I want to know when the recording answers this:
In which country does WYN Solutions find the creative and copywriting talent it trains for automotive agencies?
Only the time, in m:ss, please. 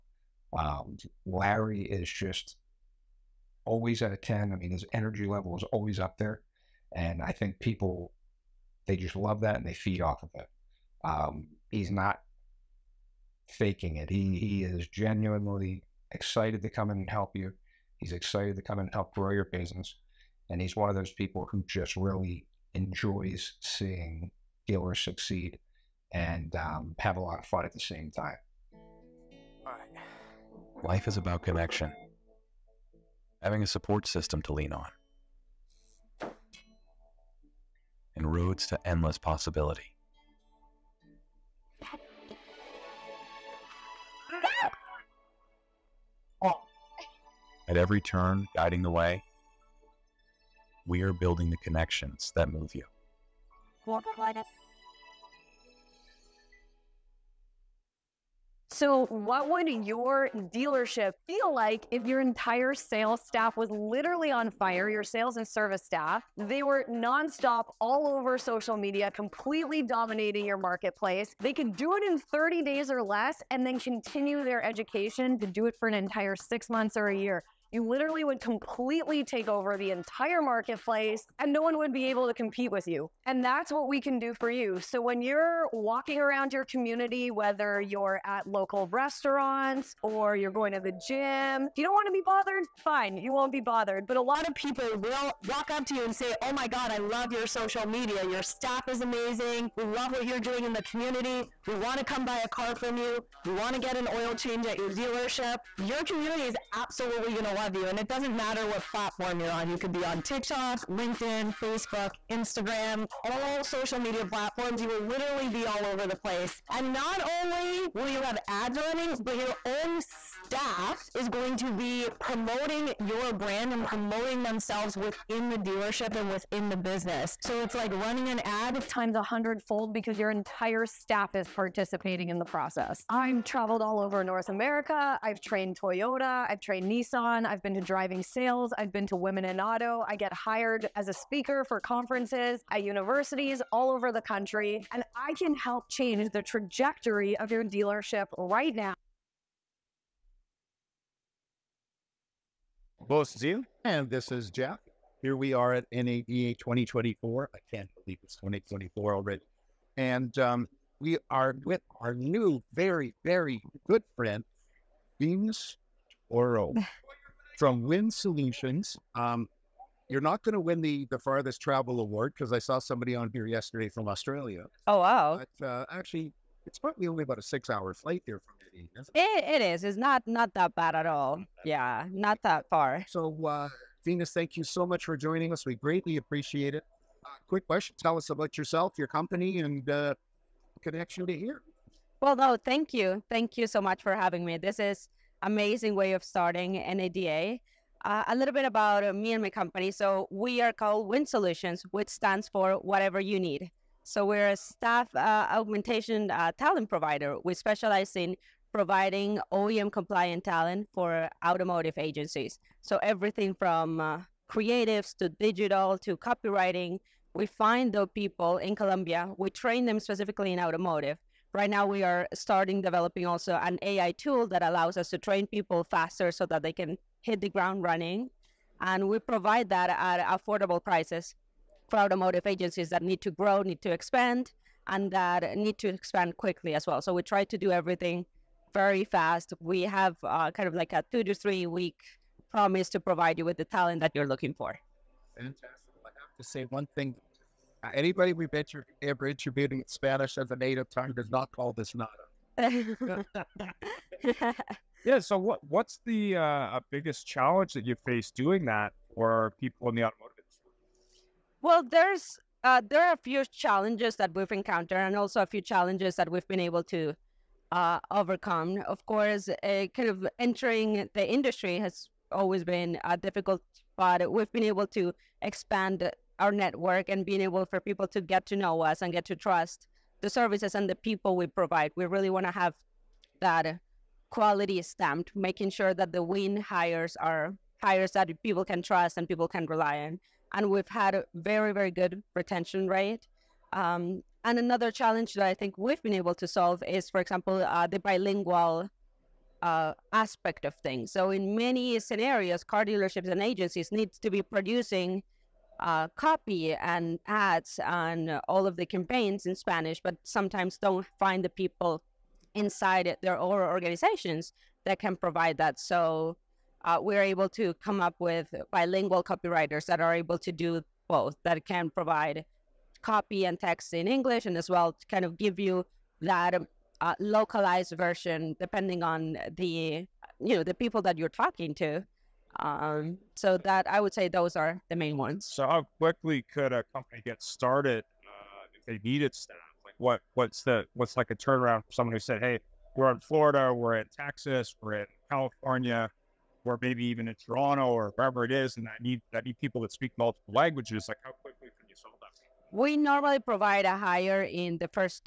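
3:38.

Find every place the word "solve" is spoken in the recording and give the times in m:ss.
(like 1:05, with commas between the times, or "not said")
4:56, 5:51.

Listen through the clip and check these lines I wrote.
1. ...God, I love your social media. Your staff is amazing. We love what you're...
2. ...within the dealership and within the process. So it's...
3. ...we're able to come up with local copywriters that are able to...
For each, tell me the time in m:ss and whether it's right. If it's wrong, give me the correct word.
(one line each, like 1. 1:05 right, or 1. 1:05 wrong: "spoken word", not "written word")
1. 1:36 right
2. 2:04 wrong: "business", not "process"
3. 5:16 wrong: "bilingual", not "local".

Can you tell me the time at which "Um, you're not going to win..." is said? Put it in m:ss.
2:49.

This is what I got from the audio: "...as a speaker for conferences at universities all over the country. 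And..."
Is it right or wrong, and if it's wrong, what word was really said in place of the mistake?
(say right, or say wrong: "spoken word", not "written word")
right.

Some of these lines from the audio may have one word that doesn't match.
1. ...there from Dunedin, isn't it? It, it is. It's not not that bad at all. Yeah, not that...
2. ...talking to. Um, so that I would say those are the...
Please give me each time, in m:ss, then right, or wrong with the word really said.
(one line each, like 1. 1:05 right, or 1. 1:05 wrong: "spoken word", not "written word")
1. 2:58 right
2. 5:31 right.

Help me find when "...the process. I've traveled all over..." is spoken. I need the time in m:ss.
2:12.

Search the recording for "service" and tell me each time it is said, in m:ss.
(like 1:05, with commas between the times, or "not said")
1:05, 4:40.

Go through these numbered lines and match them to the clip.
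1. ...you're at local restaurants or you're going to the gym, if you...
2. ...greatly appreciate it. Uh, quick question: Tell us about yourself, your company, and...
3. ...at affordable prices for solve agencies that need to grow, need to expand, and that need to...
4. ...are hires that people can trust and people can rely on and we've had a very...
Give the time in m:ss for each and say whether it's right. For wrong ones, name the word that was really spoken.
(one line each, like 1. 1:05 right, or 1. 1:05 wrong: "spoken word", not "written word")
1. 1:27 right
2. 3:05 right
3. 3:49 wrong: "automotive", not "solve"
4. 4:47 right.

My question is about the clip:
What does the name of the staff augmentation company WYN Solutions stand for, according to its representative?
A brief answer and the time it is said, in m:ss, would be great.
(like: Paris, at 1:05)
Whatever you need, at 3:22.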